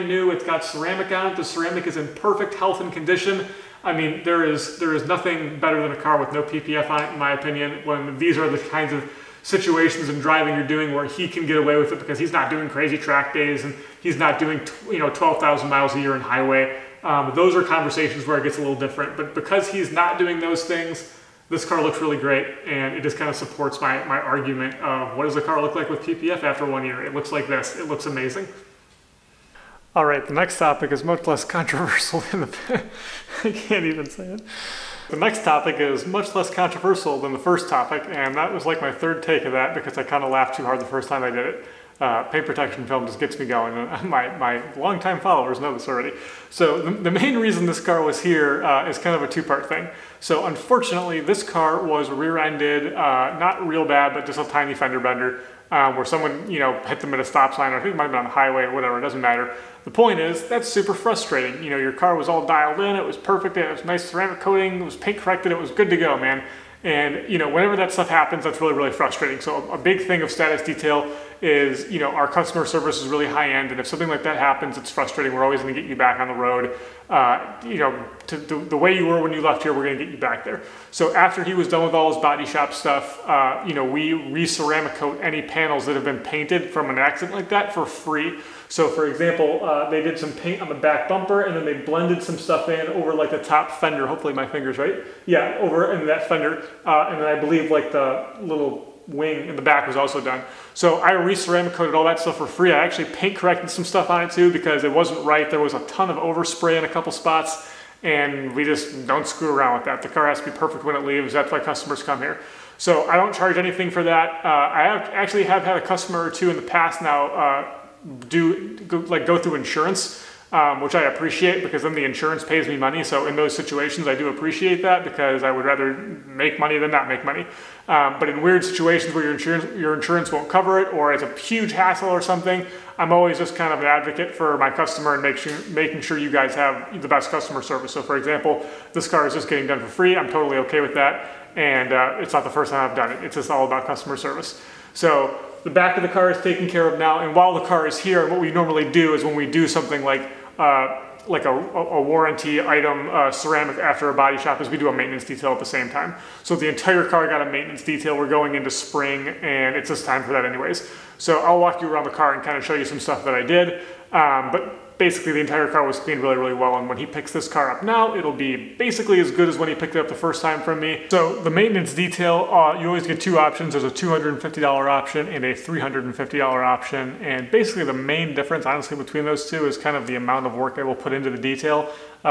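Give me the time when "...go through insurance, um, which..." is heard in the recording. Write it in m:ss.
1:59.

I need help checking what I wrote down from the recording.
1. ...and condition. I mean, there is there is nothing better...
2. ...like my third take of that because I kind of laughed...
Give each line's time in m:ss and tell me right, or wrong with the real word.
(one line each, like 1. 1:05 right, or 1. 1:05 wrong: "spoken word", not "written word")
1. 0:02 right
2. 0:38 right.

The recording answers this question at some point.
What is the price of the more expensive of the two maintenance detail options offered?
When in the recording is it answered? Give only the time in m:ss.
2:55.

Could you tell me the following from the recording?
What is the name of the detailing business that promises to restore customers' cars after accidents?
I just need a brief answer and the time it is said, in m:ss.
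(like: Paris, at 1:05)
Status Detail, at 1:10.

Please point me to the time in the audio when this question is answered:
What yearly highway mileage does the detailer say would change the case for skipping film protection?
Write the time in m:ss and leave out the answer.
0:15.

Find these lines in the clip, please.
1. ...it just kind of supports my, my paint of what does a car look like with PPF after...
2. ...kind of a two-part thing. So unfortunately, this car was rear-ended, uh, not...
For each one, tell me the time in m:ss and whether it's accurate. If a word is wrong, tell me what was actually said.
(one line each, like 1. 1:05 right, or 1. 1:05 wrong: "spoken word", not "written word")
1. 0:22 wrong: "argument", not "paint"
2. 0:48 right.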